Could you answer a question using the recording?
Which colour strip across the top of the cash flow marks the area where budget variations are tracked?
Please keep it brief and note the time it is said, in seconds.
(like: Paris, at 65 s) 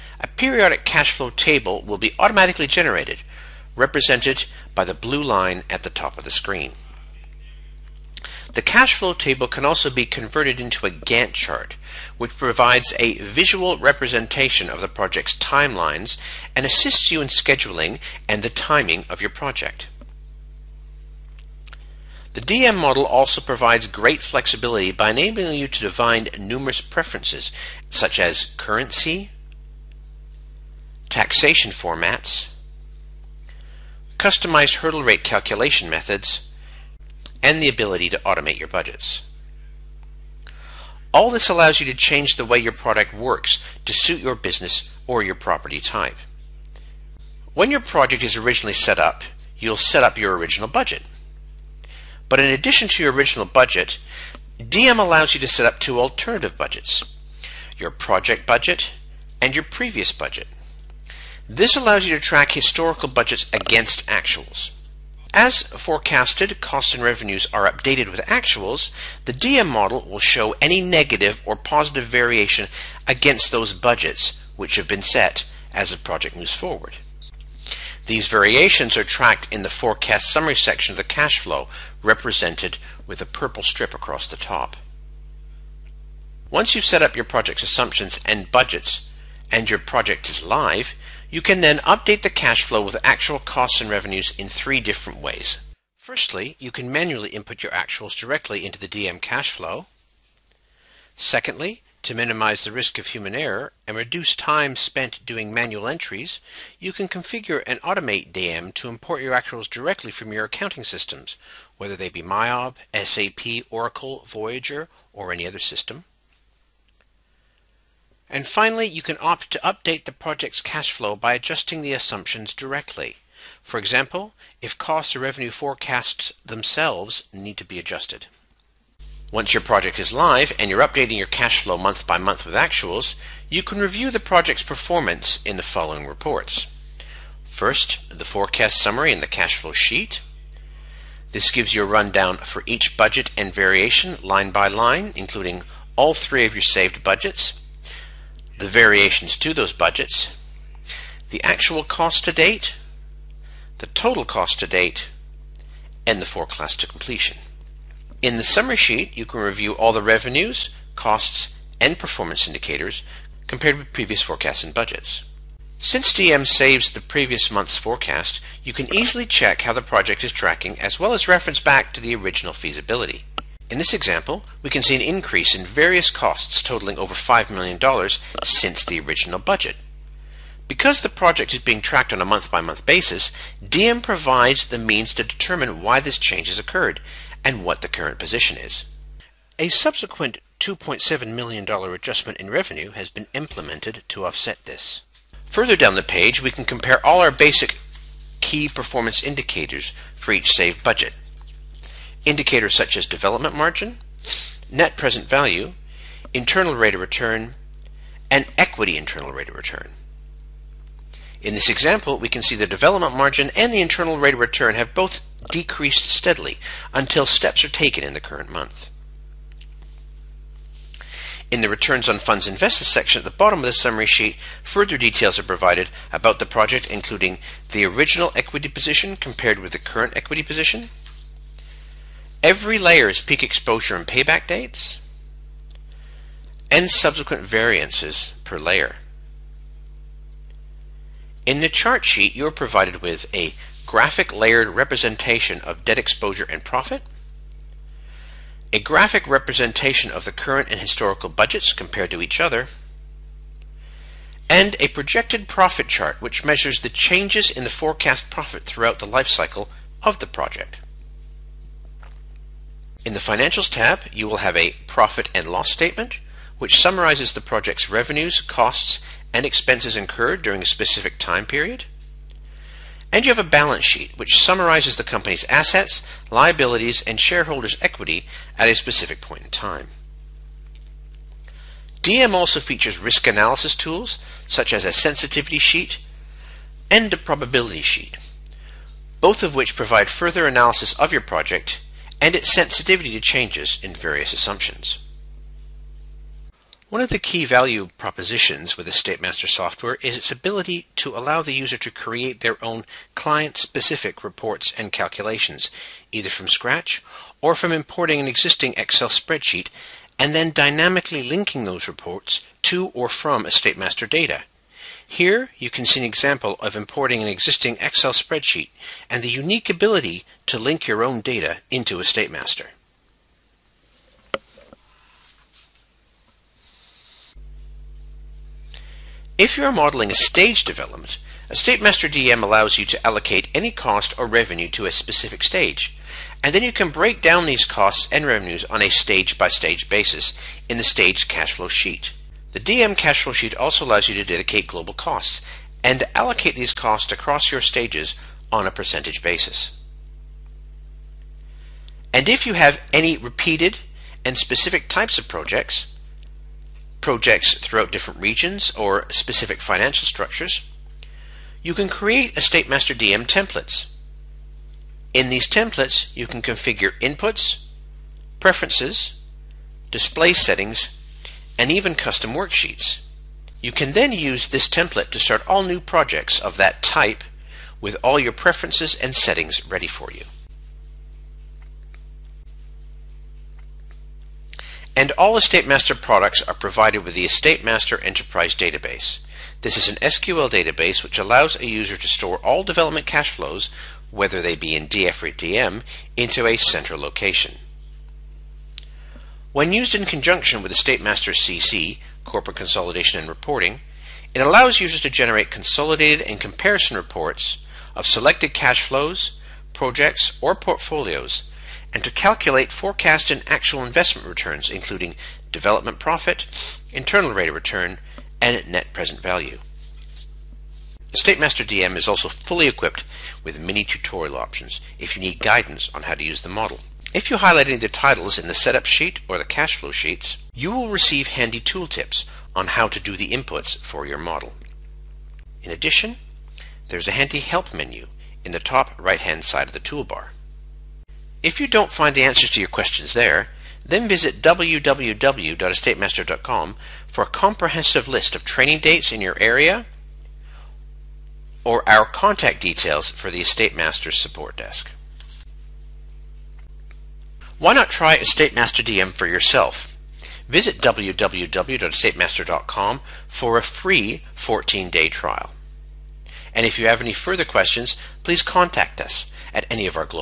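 purple, at 83 s.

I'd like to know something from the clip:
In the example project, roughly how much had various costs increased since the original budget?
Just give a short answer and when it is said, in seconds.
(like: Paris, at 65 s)
over $5 million, at 176 s.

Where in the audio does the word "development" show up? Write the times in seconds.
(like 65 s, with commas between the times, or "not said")
203 s, 212 s, 330 s, 392 s, 415 s.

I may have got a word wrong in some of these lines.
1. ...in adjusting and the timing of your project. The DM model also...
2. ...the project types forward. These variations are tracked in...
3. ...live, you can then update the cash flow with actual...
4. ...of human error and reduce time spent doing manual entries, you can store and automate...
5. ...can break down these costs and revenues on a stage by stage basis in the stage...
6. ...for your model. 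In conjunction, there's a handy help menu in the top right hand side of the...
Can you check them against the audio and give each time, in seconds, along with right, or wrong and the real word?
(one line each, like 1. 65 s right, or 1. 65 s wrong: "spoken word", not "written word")
1. 17 s wrong: "scheduling", not "adjusting"
2. 75 s wrong: "moves", not "types"
3. 90 s right
4. 102 s wrong: "configure", not "store"
5. 336 s right
6. 433 s wrong: "addition", not "conjunction".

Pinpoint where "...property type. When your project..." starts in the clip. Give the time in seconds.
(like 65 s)
45 s.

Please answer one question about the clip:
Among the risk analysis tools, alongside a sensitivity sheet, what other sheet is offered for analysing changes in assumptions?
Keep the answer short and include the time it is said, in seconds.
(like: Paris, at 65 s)
probability sheet, at 287 s.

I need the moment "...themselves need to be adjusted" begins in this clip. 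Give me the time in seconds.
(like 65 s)
126 s.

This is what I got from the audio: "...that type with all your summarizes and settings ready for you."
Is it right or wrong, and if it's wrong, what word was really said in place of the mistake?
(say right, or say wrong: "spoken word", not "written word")
wrong: "preferences", not "summarizes".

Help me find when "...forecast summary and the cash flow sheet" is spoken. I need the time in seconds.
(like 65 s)
138 s.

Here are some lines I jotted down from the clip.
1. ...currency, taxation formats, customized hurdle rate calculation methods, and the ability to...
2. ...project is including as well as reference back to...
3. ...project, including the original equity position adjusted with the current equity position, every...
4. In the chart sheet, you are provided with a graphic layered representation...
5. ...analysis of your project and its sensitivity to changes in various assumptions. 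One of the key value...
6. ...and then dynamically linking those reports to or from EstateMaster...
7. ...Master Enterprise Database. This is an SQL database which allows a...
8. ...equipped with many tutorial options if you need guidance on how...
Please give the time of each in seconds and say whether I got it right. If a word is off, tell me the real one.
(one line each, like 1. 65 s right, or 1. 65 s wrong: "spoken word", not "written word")
1. 28 s right
2. 169 s wrong: "tracking", not "including"
3. 226 s wrong: "compared", not "adjusted"
4. 241 s right
5. 290 s right
6. 310 s right
7. 387 s right
8. 422 s right.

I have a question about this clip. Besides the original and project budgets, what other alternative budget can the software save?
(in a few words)
previous budget.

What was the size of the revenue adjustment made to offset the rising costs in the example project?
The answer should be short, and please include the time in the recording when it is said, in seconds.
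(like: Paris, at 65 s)
$2.7 million, at 190 s.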